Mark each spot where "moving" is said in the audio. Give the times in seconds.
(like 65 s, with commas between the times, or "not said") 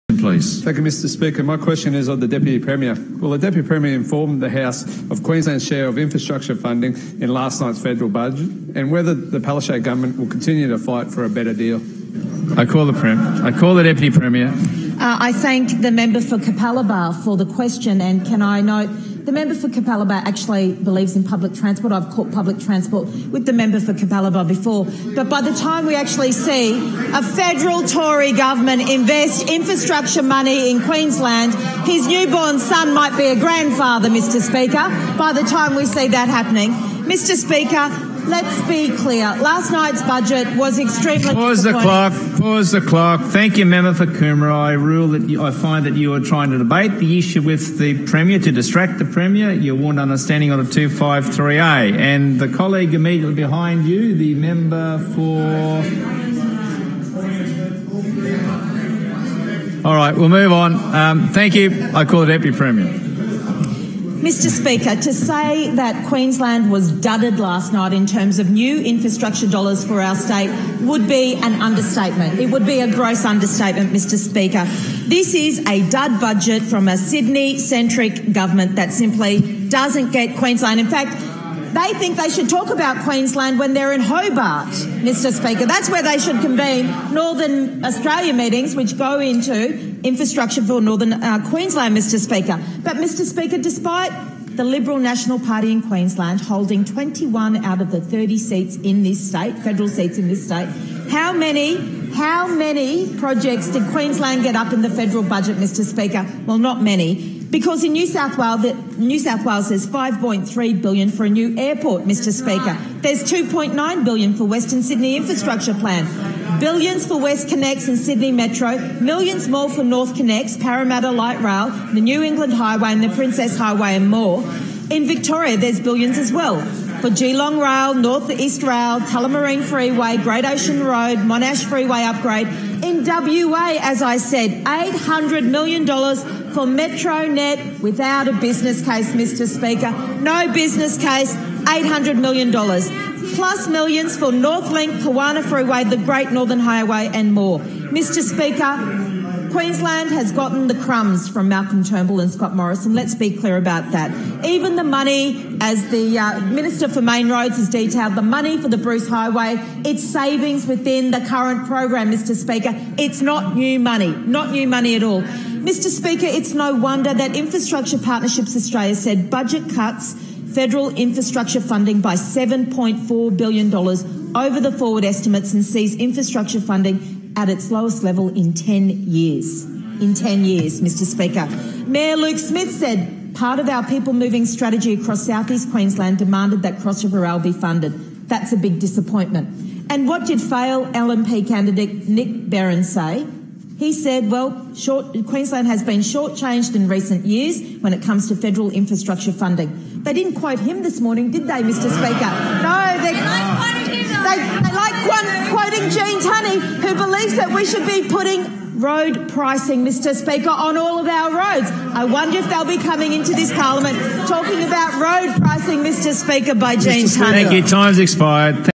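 184 s.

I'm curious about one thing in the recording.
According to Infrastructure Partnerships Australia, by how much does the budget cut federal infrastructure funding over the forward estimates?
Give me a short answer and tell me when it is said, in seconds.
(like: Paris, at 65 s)
$7.4 billion, at 172 s.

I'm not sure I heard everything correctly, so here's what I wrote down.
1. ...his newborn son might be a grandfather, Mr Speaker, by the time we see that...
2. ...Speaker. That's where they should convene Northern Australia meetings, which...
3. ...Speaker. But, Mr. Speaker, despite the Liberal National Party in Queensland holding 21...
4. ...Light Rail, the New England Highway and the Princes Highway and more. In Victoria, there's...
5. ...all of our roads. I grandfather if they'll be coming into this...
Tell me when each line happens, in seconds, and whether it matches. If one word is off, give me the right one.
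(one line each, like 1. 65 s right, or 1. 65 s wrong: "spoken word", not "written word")
1. 31 s right
2. 85 s right
3. 92 s right
4. 121 s right
5. 210 s wrong: "wonder", not "grandfather".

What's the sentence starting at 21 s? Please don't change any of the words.
I've caught public transport with the member for Capalaba before.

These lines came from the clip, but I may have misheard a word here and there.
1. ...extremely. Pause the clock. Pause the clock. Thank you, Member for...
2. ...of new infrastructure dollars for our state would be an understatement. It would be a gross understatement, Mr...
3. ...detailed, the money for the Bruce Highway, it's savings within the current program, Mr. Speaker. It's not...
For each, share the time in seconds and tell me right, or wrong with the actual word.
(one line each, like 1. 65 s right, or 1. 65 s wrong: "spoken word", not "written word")
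1. 40 s right
2. 68 s right
3. 157 s right.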